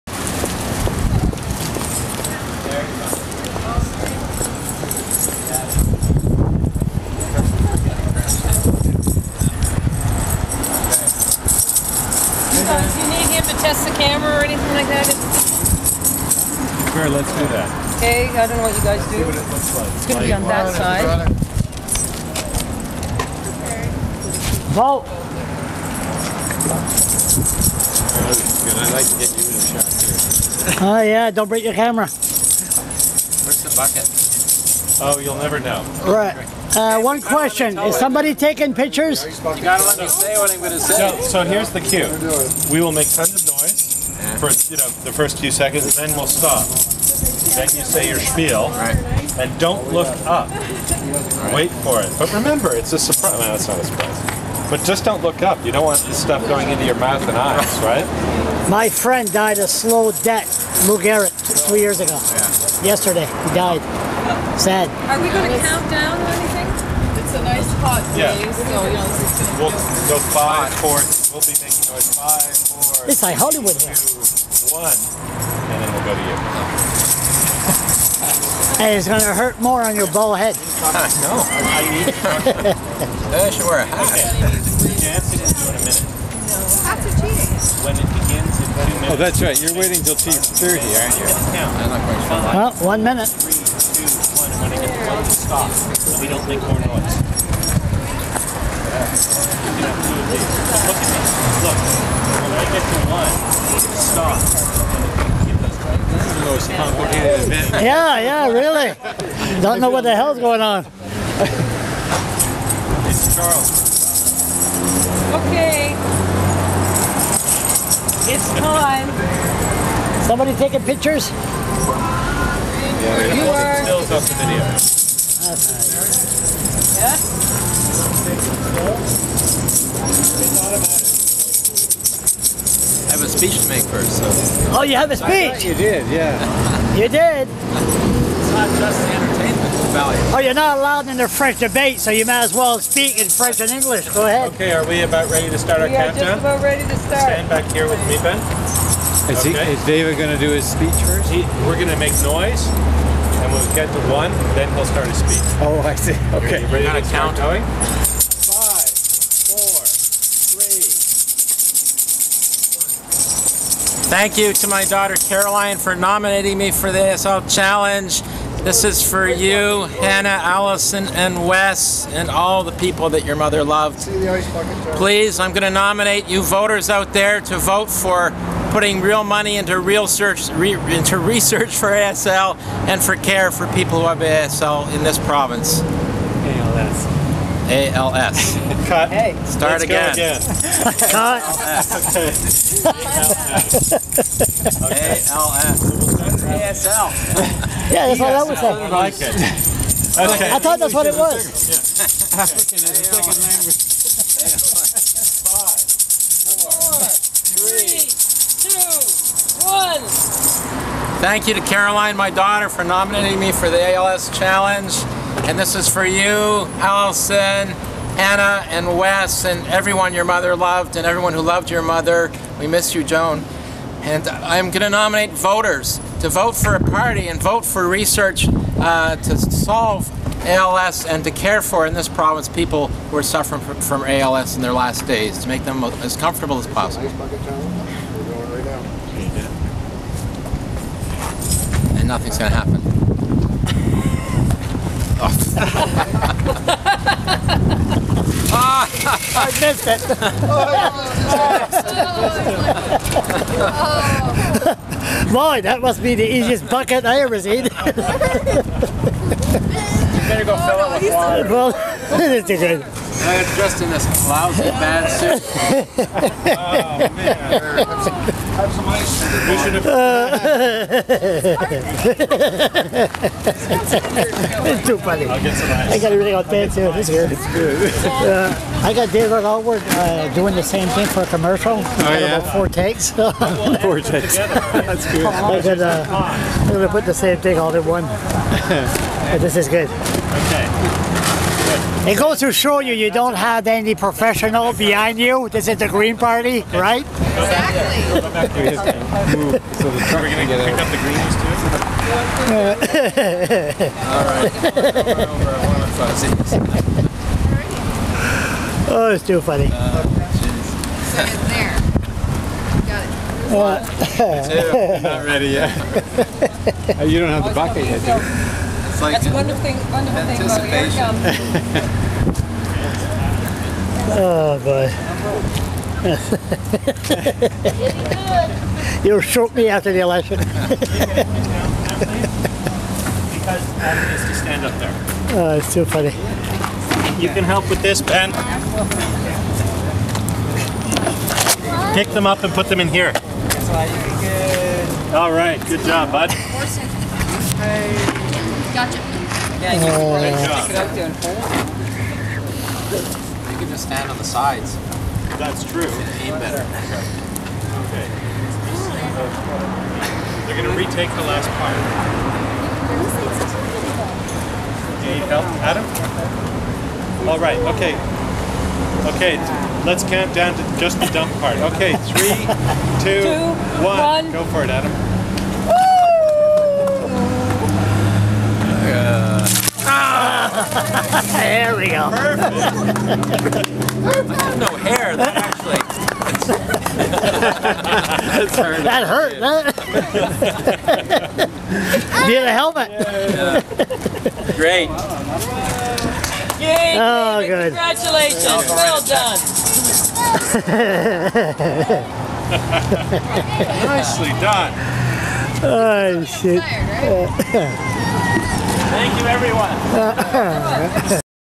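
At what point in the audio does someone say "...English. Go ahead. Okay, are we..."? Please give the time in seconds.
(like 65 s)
143 s.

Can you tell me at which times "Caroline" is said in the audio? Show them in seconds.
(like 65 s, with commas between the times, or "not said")
165 s, 211 s.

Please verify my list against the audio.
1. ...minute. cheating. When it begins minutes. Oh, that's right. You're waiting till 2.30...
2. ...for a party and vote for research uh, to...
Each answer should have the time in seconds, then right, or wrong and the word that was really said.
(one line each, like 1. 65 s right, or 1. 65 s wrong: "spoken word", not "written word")
1. 85 s right
2. 226 s right.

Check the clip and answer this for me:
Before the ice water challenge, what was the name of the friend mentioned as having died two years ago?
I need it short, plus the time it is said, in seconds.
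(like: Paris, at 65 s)
Lou Garrett, at 60 s.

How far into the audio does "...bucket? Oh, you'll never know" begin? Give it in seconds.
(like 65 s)
33 s.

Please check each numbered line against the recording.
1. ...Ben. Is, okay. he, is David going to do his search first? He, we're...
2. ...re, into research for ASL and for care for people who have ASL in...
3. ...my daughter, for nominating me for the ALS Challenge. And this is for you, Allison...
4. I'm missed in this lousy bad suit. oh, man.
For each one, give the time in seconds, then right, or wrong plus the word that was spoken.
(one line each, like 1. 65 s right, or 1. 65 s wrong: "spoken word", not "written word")
1. 148 s wrong: "speech", not "search"
2. 180 s right
3. 212 s right
4. 263 s wrong: "dressed", not "missed".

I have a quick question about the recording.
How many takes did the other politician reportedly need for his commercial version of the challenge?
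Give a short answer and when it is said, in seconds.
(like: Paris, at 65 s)
4, at 282 s.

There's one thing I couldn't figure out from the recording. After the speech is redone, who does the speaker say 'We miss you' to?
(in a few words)
Joan.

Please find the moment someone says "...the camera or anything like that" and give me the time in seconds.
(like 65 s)
13 s.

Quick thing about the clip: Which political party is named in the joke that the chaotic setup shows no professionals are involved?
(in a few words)
Green Party.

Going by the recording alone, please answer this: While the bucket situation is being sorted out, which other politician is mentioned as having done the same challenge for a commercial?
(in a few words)
David Alward.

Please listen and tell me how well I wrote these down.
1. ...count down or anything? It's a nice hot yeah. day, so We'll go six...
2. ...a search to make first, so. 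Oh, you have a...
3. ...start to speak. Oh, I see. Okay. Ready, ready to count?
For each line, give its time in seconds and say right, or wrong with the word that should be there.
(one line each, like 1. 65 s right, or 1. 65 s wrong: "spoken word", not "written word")
1. 65 s wrong: "five", not "six"
2. 133 s wrong: "speech", not "search"
3. 154 s right.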